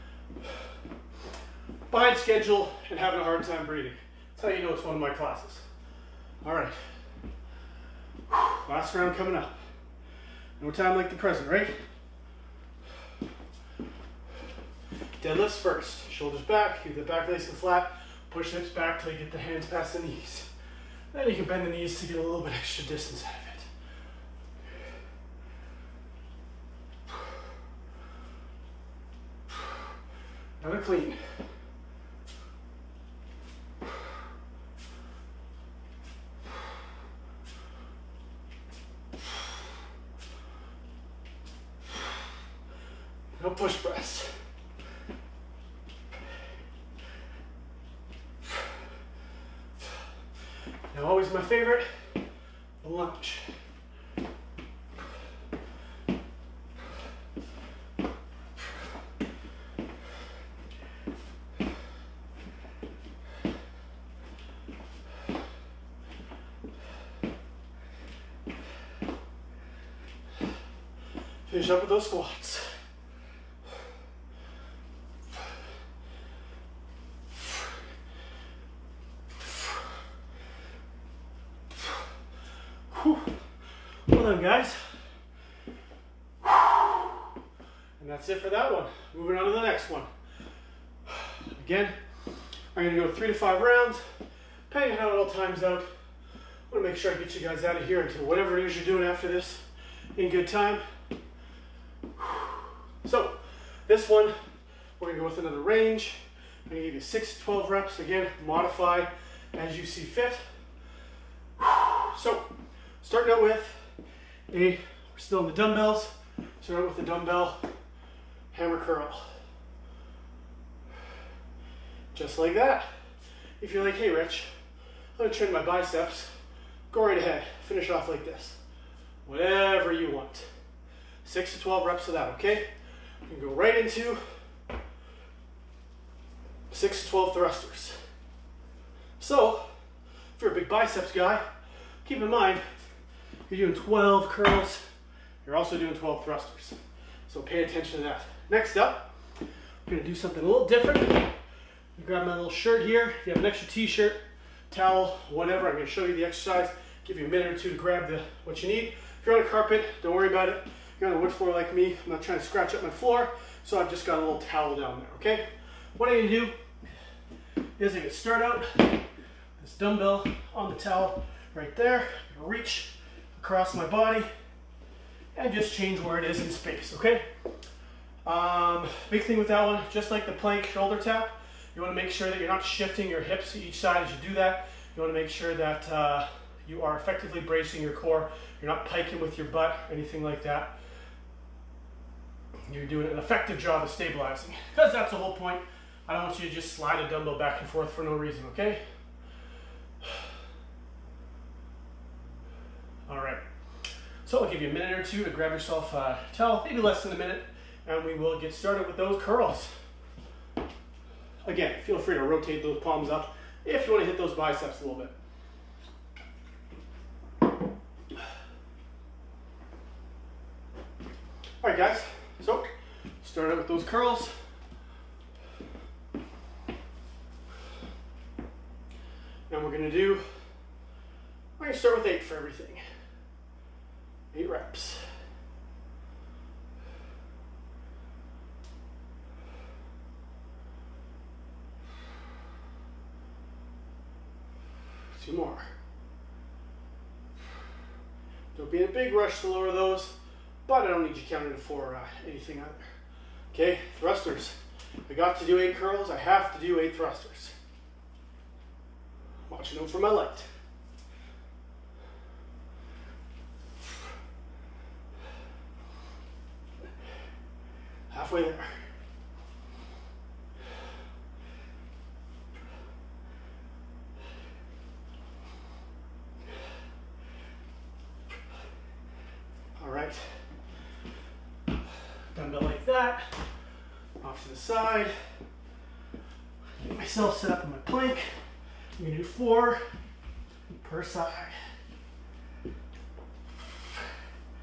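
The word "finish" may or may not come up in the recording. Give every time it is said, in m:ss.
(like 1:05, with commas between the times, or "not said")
1:11, 2:07.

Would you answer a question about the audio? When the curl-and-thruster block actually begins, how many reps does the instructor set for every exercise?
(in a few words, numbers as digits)
8.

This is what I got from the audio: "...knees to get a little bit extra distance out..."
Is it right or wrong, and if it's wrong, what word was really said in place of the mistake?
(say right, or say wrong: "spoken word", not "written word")
right.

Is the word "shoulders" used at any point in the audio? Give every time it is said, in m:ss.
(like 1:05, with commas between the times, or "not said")
0:16, 3:00.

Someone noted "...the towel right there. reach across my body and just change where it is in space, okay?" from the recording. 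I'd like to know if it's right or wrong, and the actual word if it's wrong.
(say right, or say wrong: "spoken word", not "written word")
right.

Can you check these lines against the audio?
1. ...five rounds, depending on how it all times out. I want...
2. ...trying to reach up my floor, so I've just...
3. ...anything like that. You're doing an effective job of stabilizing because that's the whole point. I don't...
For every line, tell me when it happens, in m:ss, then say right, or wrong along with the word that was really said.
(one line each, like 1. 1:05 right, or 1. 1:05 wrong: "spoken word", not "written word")
1. 1:33 right
2. 2:42 wrong: "scratch", not "reach"
3. 3:09 right.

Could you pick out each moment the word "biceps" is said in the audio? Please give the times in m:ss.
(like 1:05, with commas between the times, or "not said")
2:05, 2:20, 3:34.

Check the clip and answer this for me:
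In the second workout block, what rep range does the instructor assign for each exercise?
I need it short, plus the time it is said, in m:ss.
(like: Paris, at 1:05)
6 to 12, at 1:47.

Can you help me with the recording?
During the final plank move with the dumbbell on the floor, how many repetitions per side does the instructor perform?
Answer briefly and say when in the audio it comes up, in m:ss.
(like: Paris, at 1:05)
4, at 4:49.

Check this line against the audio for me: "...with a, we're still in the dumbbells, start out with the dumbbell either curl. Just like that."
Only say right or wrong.
wrong.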